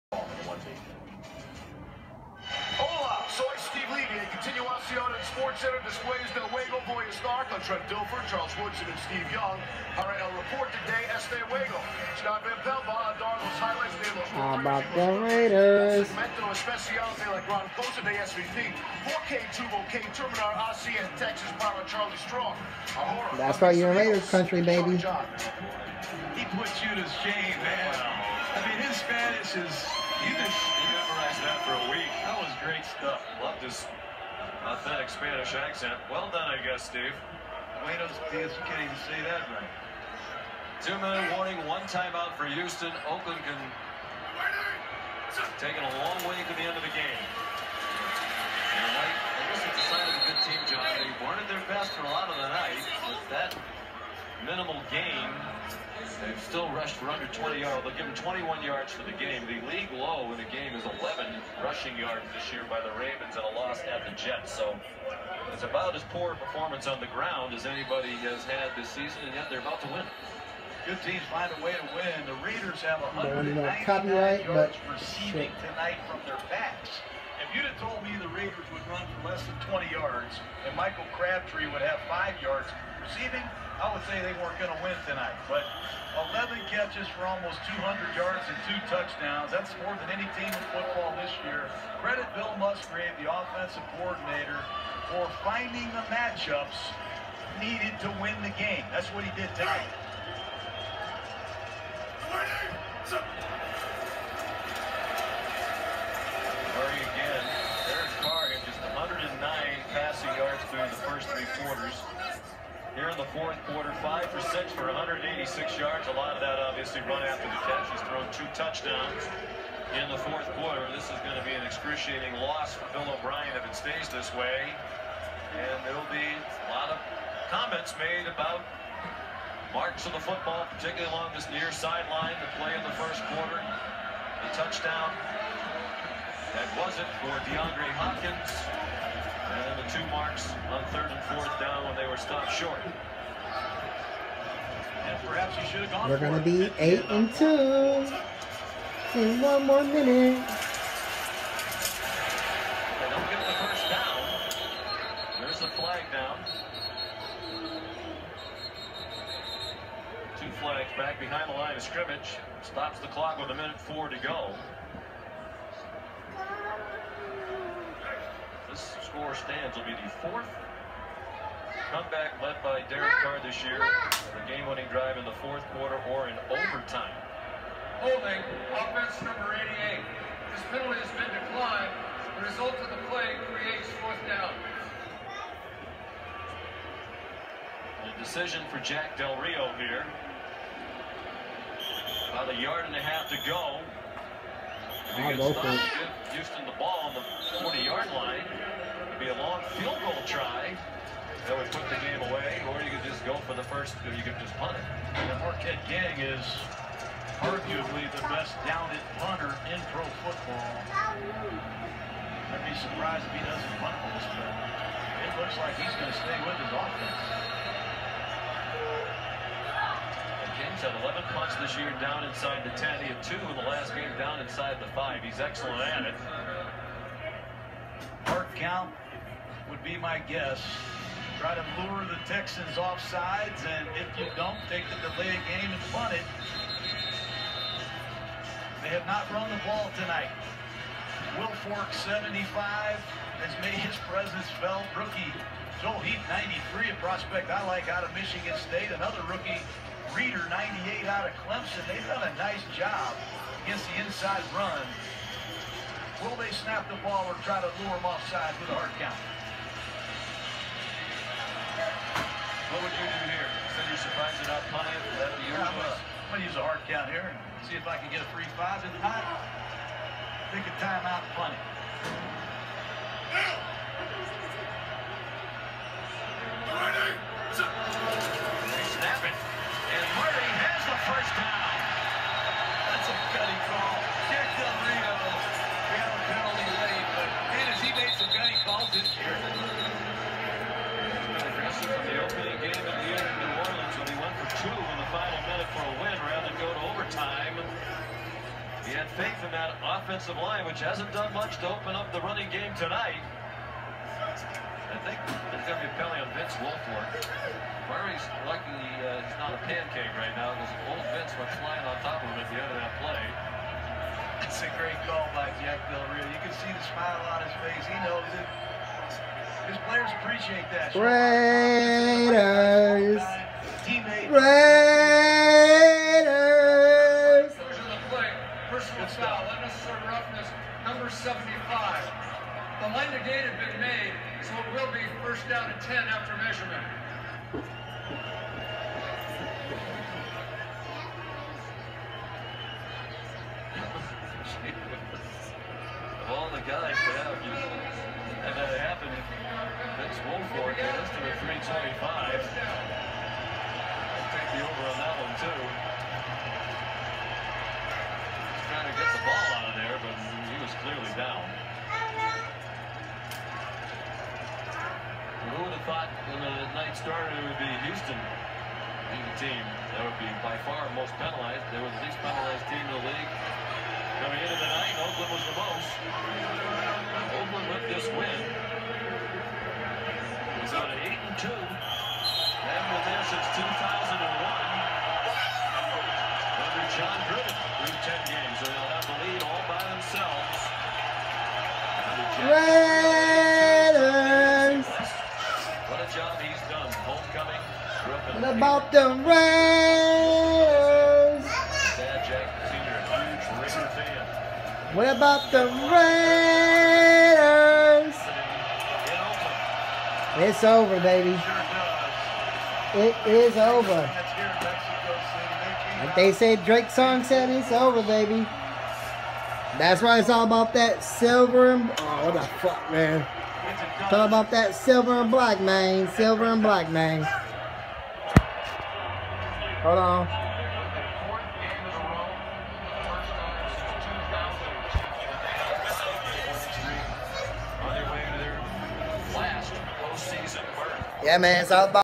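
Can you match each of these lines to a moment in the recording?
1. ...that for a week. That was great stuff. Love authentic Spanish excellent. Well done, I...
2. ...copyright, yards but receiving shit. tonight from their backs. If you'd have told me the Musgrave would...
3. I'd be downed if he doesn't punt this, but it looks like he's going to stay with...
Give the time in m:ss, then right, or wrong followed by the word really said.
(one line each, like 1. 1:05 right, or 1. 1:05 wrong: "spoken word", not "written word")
1. 0:31 wrong: "accent", not "excellent"
2. 1:13 wrong: "Raiders", not "Musgrave"
3. 3:30 wrong: "surprised", not "downed".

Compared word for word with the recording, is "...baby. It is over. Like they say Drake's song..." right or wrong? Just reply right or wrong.
right.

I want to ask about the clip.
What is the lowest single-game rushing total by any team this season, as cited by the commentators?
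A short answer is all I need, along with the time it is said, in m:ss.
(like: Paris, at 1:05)
11 rushing yards, at 1:01.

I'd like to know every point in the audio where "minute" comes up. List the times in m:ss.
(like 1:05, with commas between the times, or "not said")
0:40, 2:29, 2:43.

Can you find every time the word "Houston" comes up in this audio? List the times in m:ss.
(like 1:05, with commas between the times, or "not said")
0:42, 3:16, 6:07.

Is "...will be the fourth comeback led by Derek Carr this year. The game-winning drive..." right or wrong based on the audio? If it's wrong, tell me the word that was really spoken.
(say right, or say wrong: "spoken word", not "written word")
right.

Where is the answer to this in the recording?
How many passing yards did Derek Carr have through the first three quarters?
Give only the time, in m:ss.
1:48.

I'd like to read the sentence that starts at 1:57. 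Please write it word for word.
He's thrown two touchdowns in the fourth quarter.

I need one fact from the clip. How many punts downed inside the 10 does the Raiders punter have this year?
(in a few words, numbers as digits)
11.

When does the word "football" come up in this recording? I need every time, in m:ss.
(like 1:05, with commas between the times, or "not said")
1:30, 2:10, 3:30.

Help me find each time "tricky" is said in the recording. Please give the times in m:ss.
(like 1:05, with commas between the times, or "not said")
not said.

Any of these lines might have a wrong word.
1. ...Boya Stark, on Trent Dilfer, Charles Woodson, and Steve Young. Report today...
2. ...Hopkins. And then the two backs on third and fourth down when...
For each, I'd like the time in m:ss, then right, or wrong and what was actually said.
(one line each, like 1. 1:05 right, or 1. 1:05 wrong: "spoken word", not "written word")
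1. 0:06 right
2. 2:17 wrong: "marks", not "backs".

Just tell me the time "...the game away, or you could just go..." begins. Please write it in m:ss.
3:21.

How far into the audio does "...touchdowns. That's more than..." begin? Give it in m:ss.
1:28.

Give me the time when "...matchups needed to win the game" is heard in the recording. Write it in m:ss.
1:36.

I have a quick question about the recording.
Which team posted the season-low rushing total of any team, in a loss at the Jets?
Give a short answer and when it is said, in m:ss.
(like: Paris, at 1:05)
Ravens, at 1:02.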